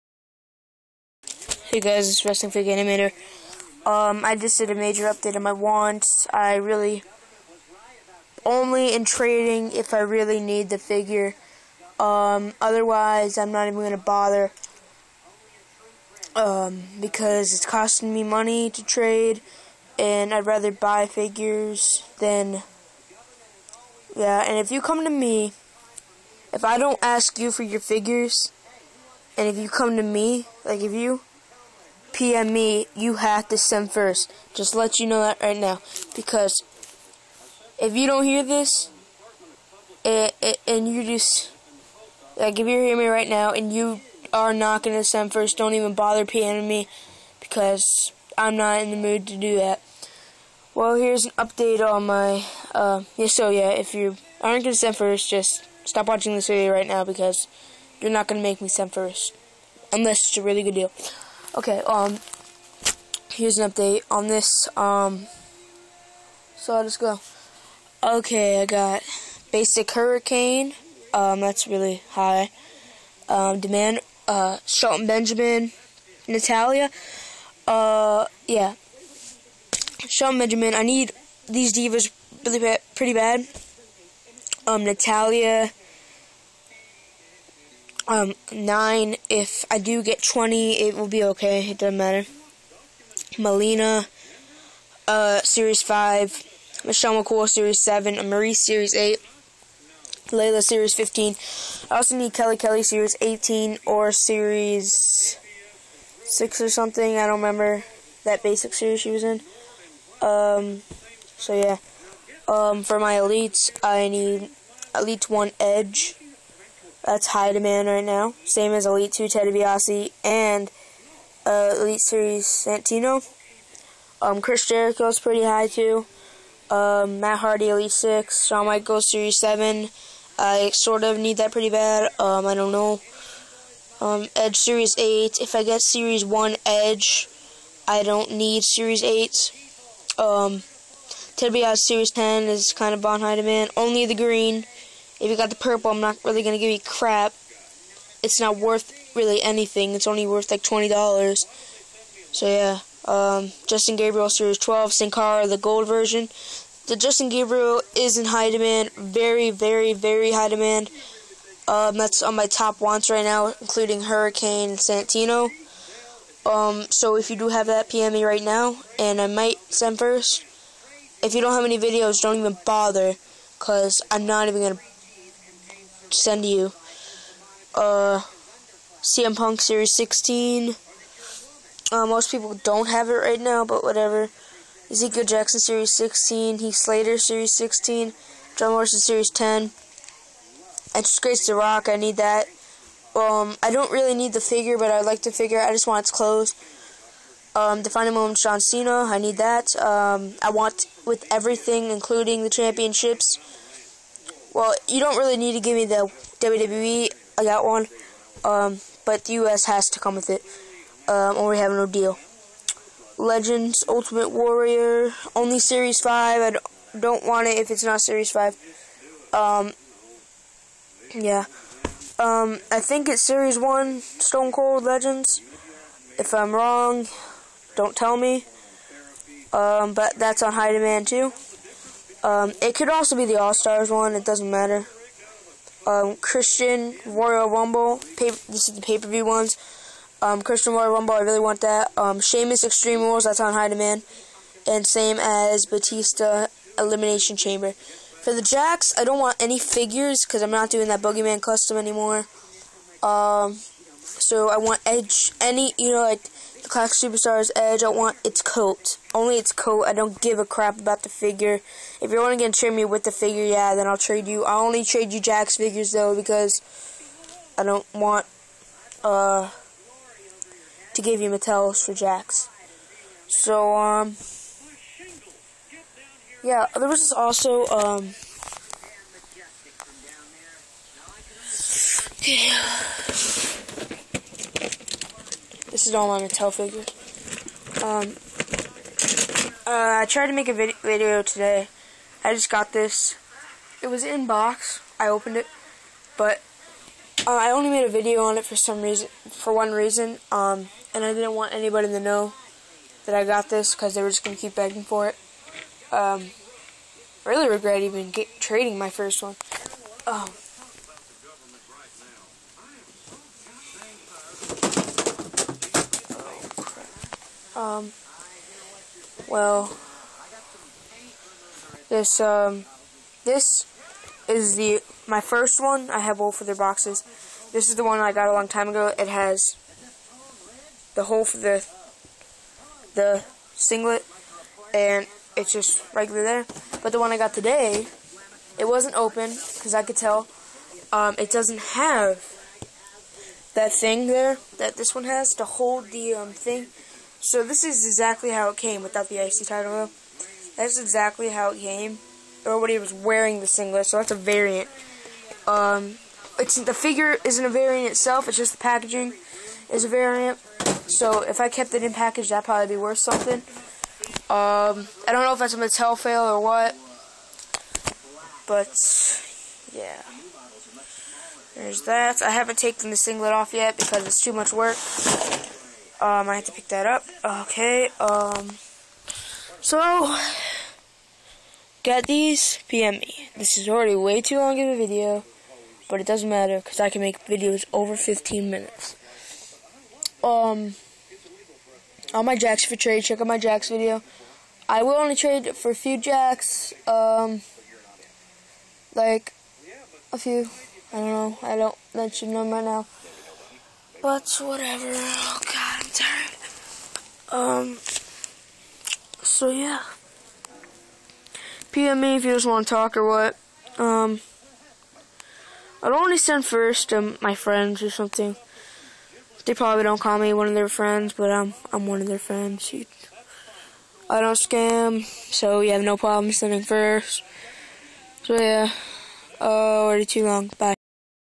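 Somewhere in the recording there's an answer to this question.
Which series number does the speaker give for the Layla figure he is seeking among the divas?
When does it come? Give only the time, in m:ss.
1:40.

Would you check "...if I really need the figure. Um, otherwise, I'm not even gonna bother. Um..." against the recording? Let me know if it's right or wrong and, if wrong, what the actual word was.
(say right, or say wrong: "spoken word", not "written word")
right.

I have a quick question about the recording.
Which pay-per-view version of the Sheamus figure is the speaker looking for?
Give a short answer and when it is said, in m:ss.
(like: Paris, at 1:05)
Extreme Rules, at 4:02.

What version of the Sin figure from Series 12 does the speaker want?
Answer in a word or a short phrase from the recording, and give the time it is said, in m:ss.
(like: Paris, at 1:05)
the gold version, at 2:34.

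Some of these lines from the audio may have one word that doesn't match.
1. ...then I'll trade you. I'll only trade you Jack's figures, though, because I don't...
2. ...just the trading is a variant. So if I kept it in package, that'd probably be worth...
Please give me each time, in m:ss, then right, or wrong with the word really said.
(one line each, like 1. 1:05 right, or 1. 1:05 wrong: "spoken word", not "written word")
1. 4:23 right
2. 5:58 wrong: "packaging", not "trading".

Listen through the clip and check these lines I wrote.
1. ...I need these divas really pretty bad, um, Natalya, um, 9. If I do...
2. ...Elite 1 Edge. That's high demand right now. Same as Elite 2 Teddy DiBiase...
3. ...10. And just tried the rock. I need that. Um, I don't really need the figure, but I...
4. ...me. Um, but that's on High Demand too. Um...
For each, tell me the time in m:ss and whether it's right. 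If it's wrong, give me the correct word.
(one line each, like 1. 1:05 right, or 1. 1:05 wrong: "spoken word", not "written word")
1. 1:20 right
2. 1:54 right
3. 3:09 wrong: "graced", not "tried"
4. 3:48 right.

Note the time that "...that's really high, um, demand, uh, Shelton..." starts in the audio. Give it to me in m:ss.
1:11.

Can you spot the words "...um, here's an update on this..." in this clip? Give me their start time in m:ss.
1:01.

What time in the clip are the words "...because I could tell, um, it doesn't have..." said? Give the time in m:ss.
5:39.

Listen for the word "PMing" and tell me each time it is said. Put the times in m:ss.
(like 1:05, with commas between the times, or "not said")
0:46.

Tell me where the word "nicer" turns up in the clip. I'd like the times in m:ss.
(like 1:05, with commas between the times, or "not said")
not said.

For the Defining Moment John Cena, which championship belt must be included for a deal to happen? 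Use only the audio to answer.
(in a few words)
U.S.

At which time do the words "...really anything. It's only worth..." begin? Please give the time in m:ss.
2:29.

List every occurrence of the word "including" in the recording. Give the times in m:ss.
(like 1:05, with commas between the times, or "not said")
2:43, 3:21.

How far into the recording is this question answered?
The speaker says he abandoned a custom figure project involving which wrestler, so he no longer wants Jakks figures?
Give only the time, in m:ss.
4:11.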